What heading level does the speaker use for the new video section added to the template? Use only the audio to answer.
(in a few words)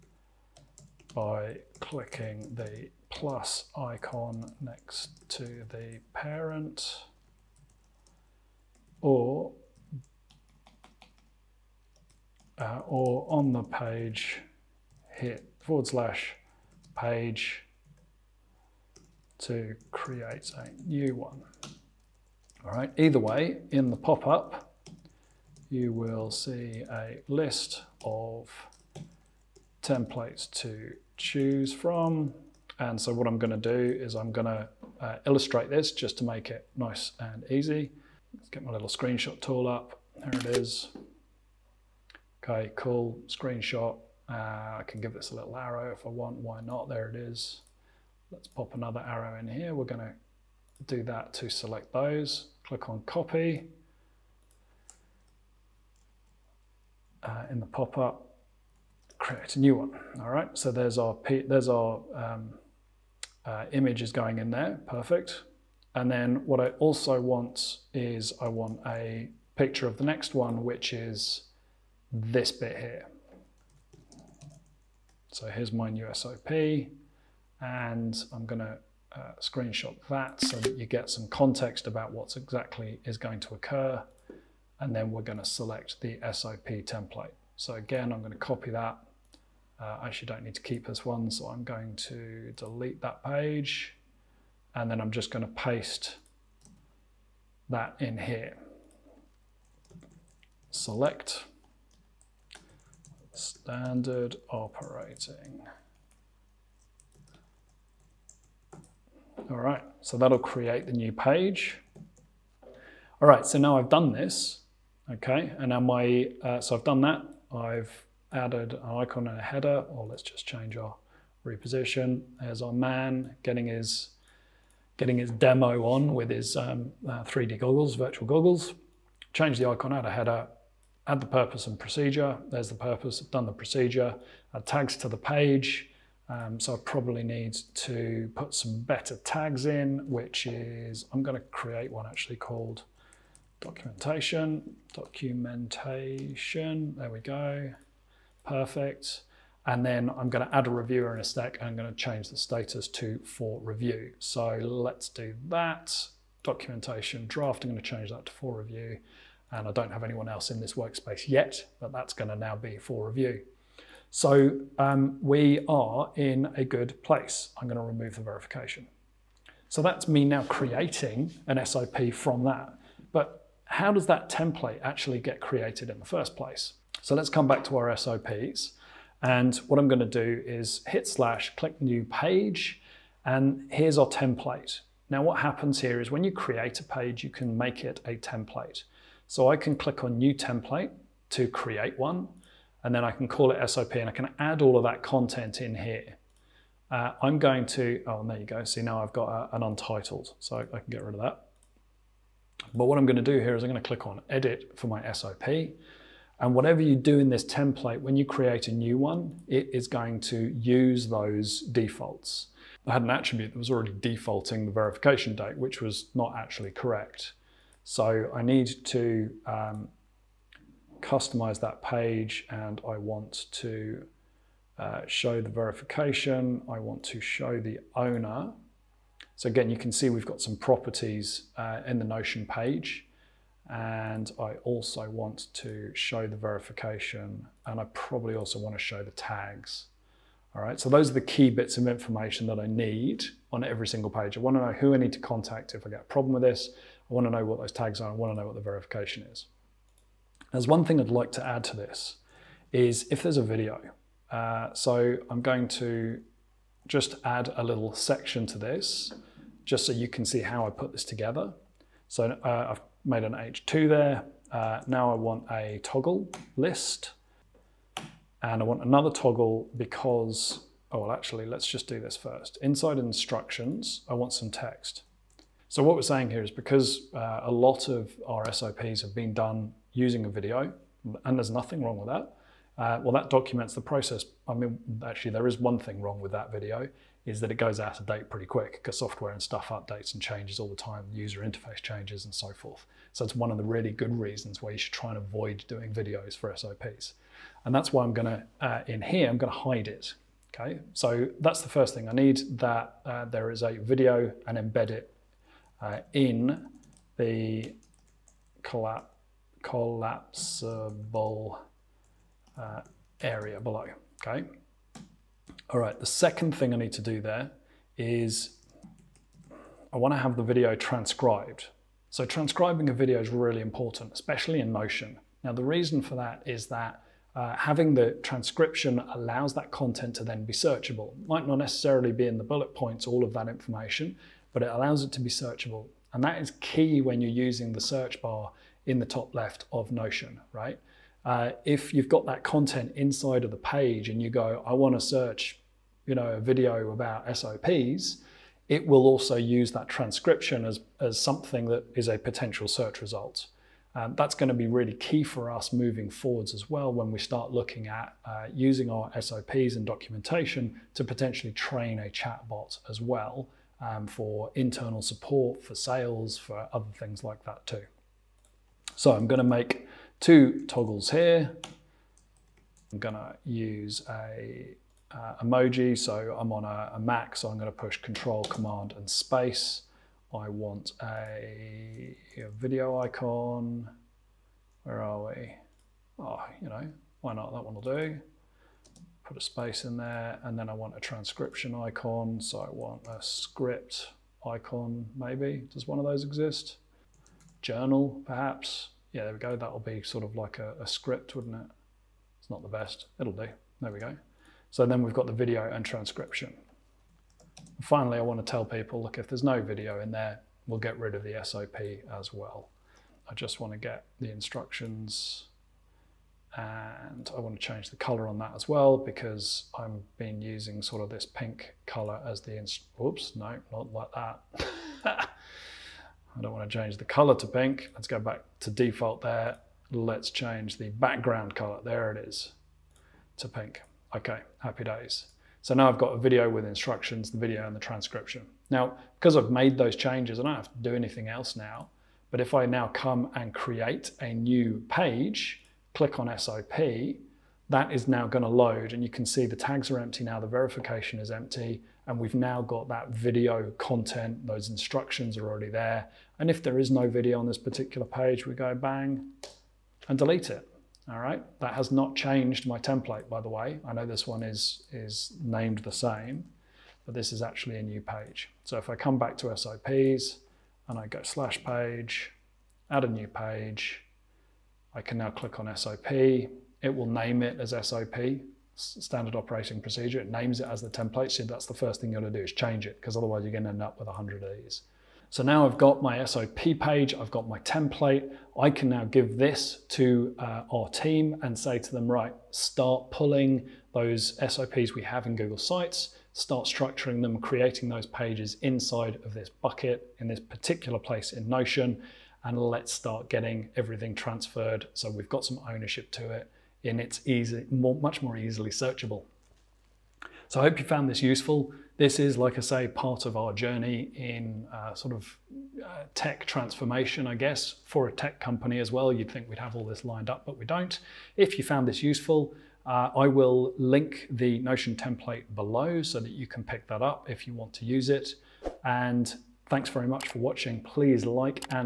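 H2.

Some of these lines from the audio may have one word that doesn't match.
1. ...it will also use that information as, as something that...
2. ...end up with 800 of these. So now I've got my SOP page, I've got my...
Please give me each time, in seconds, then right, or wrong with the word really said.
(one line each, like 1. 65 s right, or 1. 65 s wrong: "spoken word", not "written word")
1. 348 s wrong: "transcription", not "information"
2. 483 s wrong: "100", not "800".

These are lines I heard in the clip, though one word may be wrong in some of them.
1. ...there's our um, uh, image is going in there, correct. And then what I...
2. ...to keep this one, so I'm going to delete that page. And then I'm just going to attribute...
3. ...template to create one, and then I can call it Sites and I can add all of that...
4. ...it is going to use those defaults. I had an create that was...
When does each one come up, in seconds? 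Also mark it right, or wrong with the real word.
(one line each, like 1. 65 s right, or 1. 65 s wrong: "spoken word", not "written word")
1. 61 s wrong: "perfect", not "correct"
2. 90 s wrong: "paste", not "attribute"
3. 190 s wrong: "SOP", not "Sites"
4. 209 s wrong: "attribute", not "create".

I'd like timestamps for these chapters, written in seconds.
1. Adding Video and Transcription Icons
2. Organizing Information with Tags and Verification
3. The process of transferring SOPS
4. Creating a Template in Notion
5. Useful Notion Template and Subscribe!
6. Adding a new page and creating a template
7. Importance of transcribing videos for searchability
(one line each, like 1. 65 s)
1. 377 s
2. 238 s
3. 450 s
4. 161 s
5. 517 s
6. 84 s
7. 302 s.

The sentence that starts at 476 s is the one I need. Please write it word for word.
It will name it as SOP, standard operating procedure.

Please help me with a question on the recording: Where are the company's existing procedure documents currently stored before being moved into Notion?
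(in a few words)
Google Sites.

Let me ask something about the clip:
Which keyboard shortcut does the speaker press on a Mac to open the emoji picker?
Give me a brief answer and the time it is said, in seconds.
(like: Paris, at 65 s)
Control, Command, and Space, at 377 s.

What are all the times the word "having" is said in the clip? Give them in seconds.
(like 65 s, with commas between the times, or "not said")
327 s.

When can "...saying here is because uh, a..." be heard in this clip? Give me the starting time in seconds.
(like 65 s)
276 s.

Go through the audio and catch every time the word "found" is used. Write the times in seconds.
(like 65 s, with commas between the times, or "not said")
510 s, 521 s.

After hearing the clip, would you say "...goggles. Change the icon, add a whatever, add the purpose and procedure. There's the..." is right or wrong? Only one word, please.
wrong.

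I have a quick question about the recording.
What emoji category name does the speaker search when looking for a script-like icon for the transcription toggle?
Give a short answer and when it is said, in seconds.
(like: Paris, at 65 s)
Journal, at 397 s.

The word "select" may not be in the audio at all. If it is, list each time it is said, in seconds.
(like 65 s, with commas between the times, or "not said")
51 s, 85 s, 100 s.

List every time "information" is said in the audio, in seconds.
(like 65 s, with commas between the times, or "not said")
241 s, 333 s.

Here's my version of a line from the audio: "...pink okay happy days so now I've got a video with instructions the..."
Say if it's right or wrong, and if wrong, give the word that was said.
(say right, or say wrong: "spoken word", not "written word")
right.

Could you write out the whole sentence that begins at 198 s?
See, now I've got a, uh, an untitled, so I, I can get rid of that.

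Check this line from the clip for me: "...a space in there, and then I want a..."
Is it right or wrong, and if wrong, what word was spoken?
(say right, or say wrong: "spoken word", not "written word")
right.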